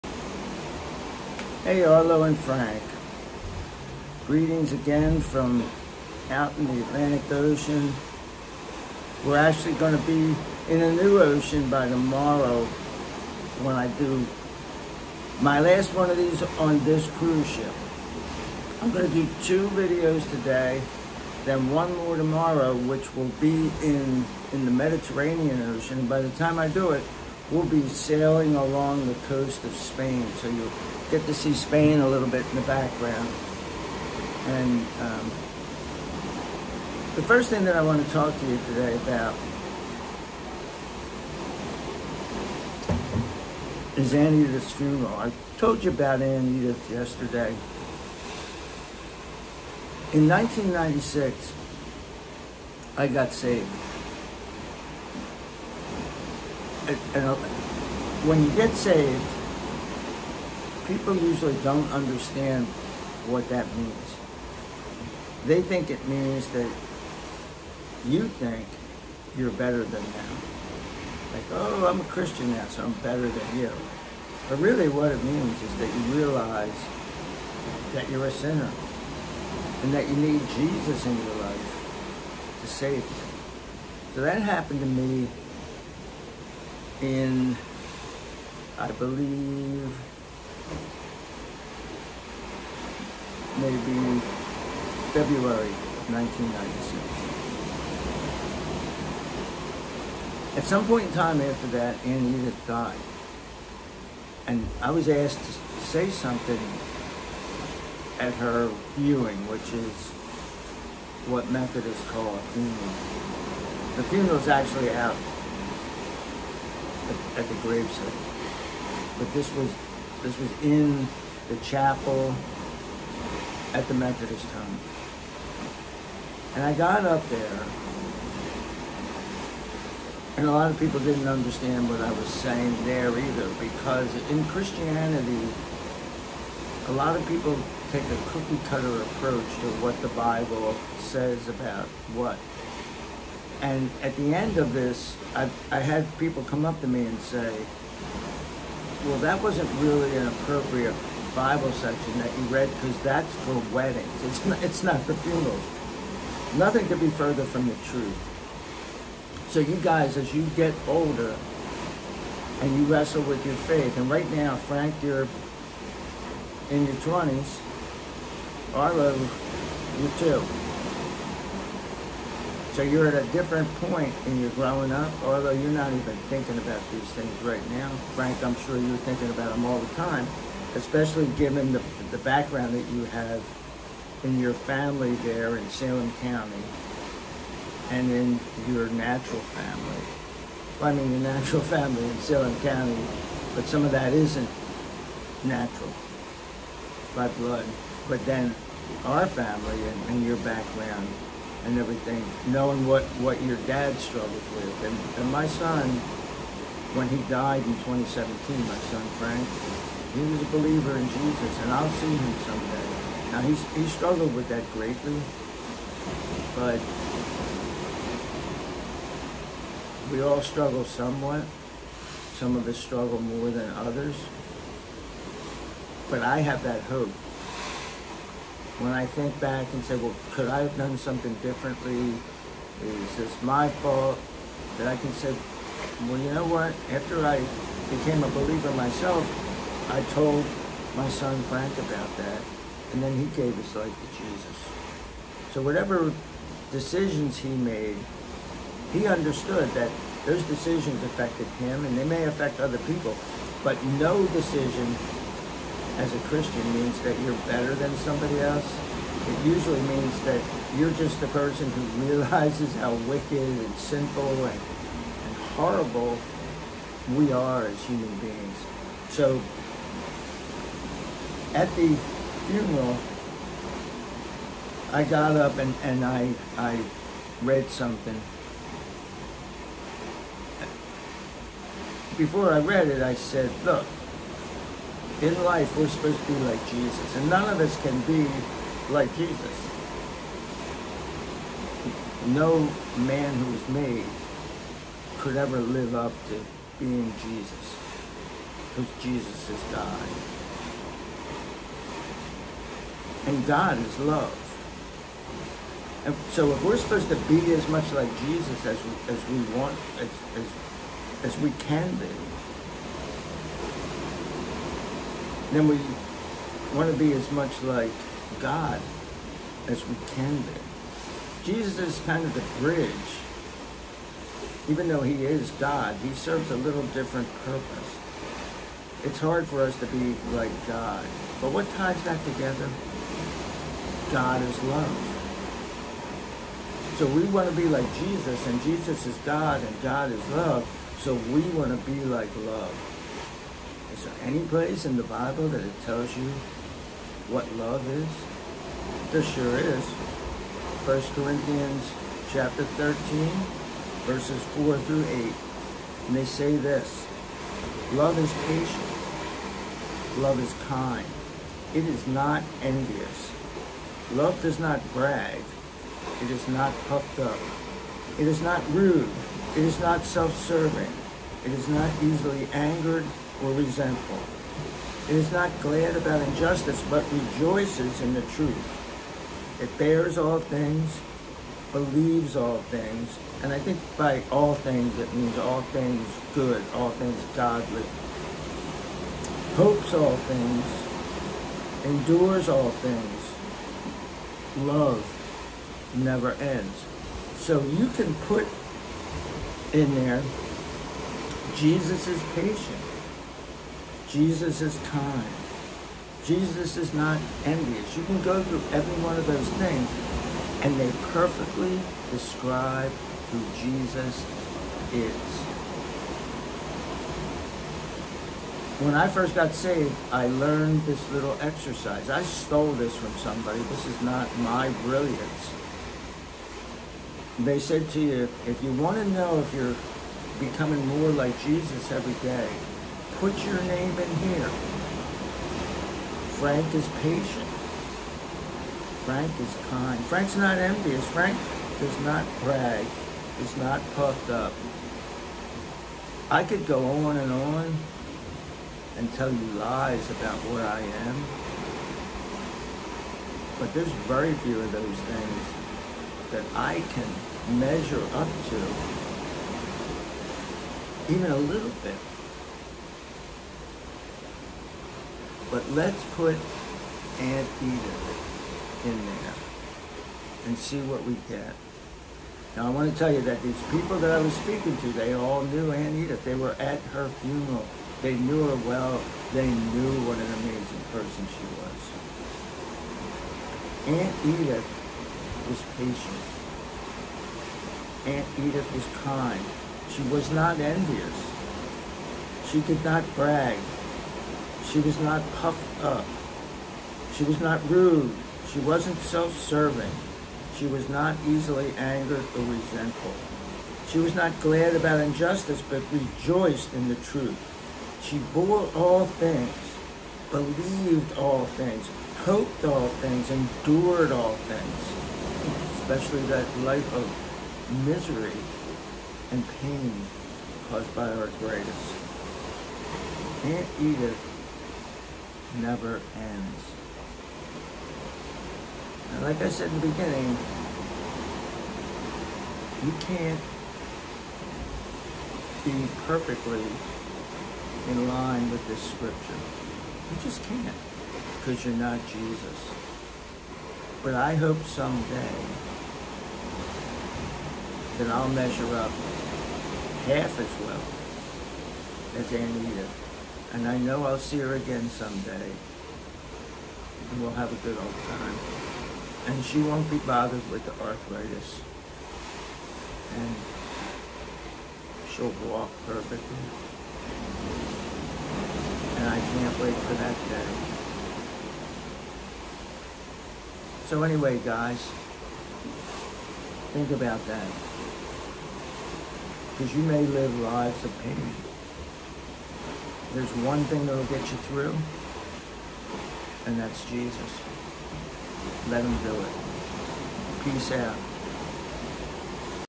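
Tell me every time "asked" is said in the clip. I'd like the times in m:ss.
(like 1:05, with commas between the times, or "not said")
1:45.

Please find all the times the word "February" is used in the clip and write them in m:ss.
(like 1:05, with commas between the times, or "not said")
1:35.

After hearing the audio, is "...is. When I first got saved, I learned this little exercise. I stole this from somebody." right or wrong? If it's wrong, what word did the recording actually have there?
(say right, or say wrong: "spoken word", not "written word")
right.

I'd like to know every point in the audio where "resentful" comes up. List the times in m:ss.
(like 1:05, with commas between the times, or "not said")
6:13, 8:22.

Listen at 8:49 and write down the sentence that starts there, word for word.
And like I said in the beginning, you can't be perfectly in line with this scripture.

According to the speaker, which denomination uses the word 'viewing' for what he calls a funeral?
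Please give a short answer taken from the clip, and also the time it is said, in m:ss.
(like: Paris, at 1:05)
Methodists, at 1:51.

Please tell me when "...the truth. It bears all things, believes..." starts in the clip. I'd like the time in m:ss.
6:18.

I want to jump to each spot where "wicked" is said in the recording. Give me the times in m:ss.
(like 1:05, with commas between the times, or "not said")
4:23.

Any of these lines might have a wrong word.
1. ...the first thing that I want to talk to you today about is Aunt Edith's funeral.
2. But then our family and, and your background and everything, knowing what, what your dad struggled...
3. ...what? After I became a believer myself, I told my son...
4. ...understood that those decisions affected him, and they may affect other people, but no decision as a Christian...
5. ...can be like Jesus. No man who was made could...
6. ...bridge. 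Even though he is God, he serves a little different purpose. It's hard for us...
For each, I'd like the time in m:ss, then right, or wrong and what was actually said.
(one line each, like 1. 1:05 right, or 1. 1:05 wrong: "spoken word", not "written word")
1. 0:37 right
2. 3:18 right
3. 3:56 right
4. 4:09 right
5. 4:47 right
6. 5:22 right.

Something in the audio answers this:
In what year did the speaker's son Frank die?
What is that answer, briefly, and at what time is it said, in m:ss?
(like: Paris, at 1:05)
2017, at 3:27.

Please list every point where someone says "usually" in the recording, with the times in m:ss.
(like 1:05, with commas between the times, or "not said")
1:01, 4:19.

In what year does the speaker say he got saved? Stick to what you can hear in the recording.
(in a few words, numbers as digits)
1996.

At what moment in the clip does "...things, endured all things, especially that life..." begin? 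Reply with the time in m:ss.
8:33.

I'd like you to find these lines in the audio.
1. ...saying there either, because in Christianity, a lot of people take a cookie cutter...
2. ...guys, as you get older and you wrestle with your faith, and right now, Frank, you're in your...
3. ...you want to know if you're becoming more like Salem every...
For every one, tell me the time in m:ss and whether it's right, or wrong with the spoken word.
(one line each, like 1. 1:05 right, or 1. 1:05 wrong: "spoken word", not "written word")
1. 2:12 right
2. 2:39 right
3. 7:08 wrong: "Jesus", not "Salem".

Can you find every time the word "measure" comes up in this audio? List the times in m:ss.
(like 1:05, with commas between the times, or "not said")
7:37, 9:08.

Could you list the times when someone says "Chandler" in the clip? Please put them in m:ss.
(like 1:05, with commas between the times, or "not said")
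not said.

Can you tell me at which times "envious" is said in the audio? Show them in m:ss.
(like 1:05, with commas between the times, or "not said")
6:02, 6:47, 7:20, 8:10.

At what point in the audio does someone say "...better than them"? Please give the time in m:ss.
1:09.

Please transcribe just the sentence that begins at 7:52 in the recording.
Now I want to tell you that these people that I was speaking to, they all knew Aunt Edith.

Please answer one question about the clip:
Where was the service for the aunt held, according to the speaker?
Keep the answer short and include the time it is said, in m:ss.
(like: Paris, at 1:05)
the Methodist home, at 2:03.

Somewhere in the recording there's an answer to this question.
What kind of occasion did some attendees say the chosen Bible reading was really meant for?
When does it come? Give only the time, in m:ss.
2:33.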